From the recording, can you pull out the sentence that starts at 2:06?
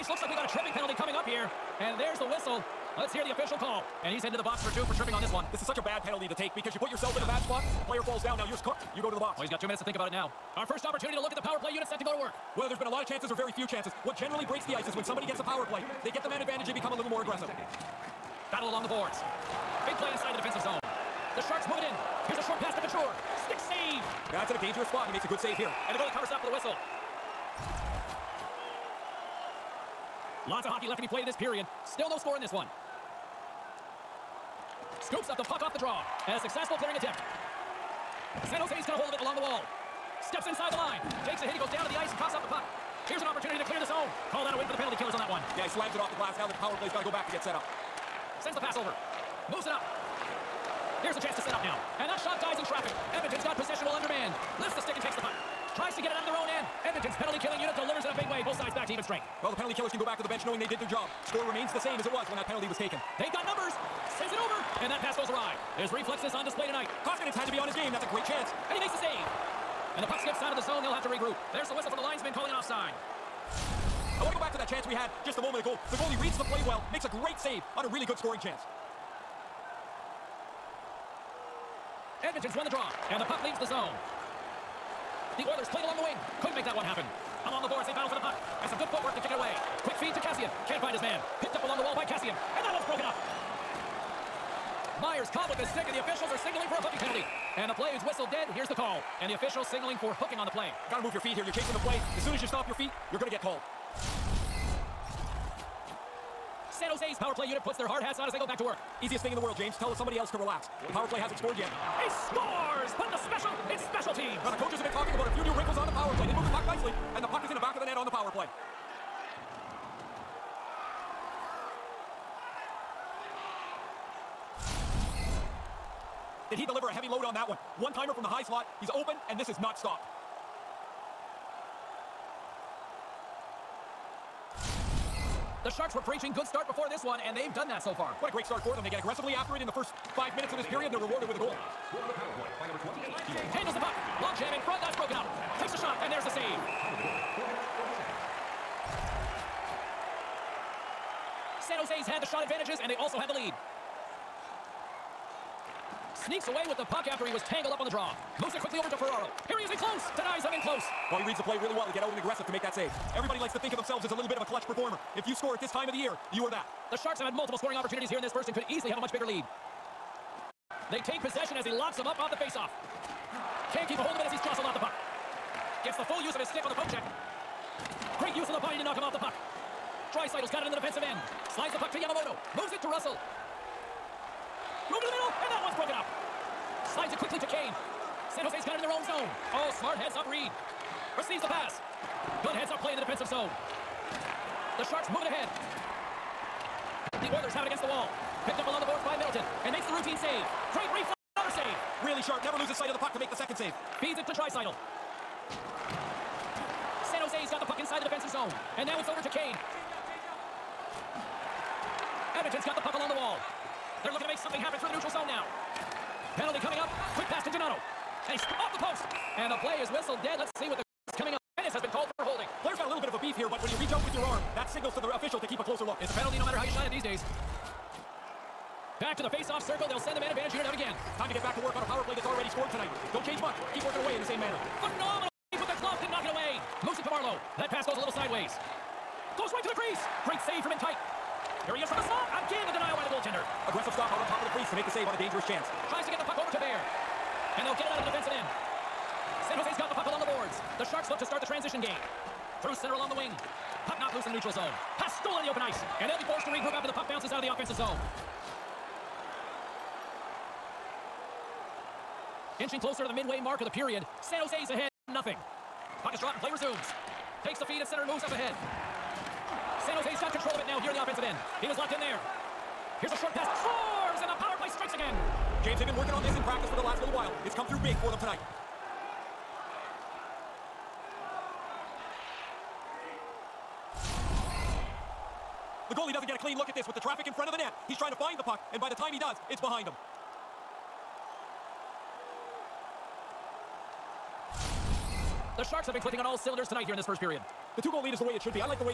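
Did he deliver a heavy load on that one?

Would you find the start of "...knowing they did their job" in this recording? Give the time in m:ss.
1:00.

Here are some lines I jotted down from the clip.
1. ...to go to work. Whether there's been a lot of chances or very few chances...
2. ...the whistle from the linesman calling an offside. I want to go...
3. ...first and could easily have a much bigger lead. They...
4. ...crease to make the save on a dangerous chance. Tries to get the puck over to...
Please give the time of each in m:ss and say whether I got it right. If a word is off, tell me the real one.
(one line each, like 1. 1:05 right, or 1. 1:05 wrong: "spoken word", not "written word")
1. 0:11 right
2. 1:11 right
3. 2:48 right
4. 4:04 right.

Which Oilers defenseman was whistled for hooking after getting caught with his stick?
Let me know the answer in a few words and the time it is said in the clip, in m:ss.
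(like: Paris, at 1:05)
Myers, at 1:35.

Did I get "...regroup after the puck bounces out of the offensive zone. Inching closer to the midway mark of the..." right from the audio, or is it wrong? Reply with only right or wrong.
right.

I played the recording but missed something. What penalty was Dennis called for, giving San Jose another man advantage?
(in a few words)
Holding.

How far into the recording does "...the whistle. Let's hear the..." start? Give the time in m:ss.
0:02.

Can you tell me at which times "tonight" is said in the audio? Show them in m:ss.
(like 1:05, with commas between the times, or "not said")
1:06, 3:52, 4:38, 4:56.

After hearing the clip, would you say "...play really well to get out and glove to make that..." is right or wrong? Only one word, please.
wrong.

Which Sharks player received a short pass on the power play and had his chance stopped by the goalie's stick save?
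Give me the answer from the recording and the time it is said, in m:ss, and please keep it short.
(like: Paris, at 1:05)
Couture, at 0:22.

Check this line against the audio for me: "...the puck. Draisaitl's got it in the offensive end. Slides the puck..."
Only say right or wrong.
wrong.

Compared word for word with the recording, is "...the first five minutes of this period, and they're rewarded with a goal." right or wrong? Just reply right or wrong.
right.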